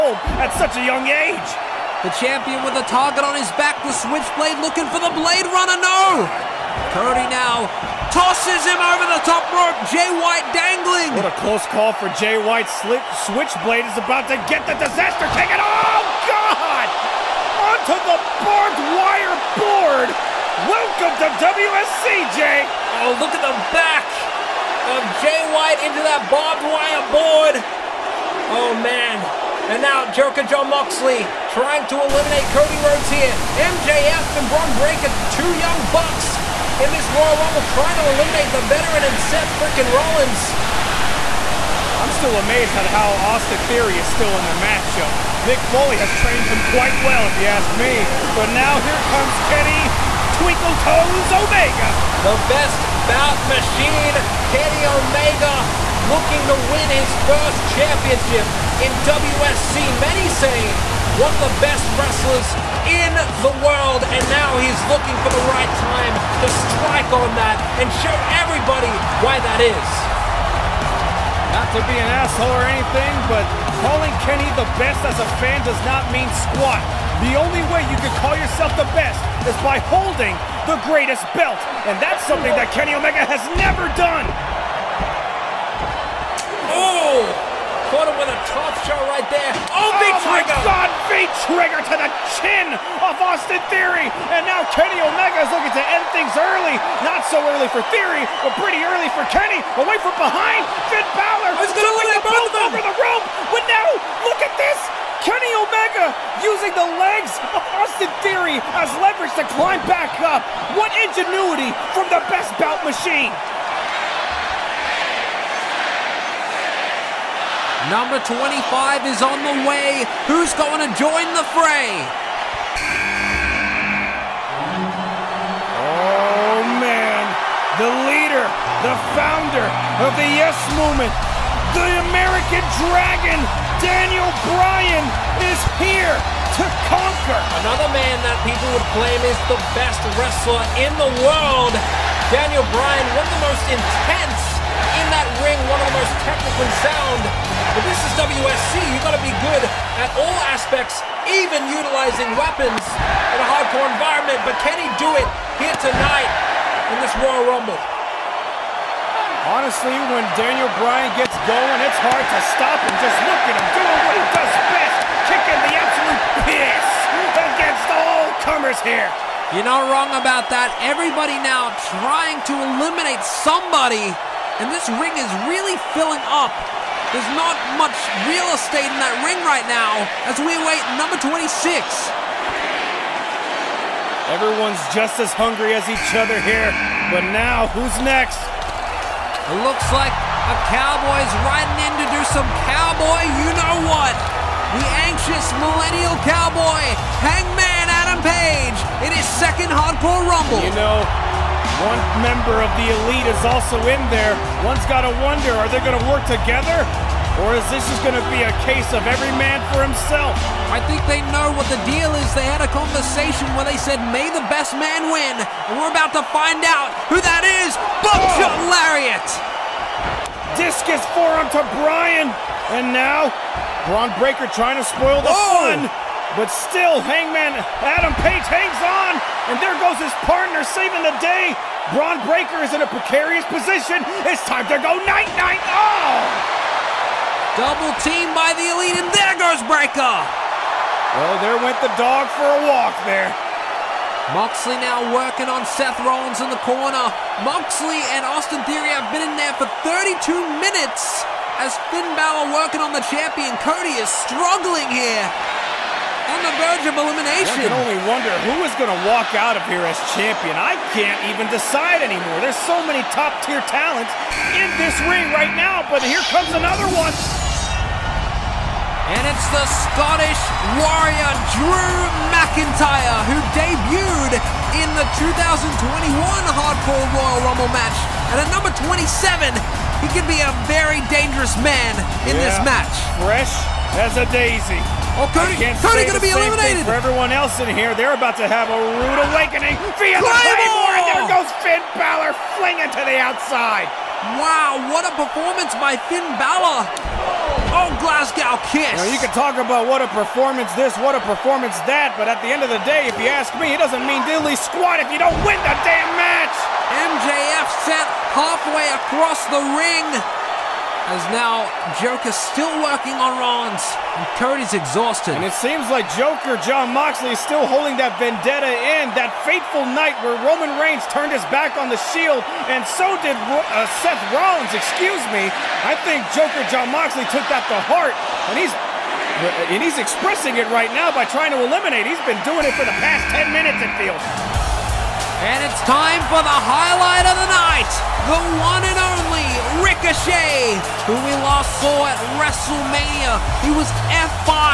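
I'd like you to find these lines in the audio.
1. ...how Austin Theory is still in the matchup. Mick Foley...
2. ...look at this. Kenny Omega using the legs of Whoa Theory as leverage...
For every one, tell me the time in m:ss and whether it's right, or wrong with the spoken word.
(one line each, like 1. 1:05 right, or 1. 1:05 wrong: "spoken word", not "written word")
1. 0:42 right
2. 1:44 wrong: "Austin", not "Whoa".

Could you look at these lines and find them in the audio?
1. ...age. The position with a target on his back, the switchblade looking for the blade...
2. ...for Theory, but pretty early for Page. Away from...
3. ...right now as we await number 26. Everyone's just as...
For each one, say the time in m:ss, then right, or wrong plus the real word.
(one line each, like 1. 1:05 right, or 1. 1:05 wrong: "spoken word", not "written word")
1. 0:01 wrong: "champion", not "position"
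2. 1:37 wrong: "Kenny", not "Page"
3. 2:59 right.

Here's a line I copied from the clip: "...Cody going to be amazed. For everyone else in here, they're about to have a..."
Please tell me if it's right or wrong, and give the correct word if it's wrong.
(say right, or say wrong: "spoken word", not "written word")
wrong: "eliminated", not "amazed".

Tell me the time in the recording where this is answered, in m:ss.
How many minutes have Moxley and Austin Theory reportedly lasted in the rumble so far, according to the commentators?
4:09.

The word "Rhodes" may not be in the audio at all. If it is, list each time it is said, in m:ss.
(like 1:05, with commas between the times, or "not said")
0:32.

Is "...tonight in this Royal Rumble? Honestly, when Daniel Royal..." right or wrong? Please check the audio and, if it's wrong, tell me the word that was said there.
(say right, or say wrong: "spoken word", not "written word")
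wrong: "Bryan", not "Royal".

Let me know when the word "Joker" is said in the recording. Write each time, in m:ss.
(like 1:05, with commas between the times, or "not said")
0:30, 5:12, 5:16, 5:26.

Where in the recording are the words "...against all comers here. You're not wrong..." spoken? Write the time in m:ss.
2:47.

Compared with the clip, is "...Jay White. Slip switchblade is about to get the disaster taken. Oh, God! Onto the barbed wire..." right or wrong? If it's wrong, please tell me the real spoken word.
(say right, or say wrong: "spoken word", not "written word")
right.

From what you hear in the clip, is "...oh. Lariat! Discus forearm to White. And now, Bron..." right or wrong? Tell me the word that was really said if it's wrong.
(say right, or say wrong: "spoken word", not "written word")
wrong: "Bryan", not "White".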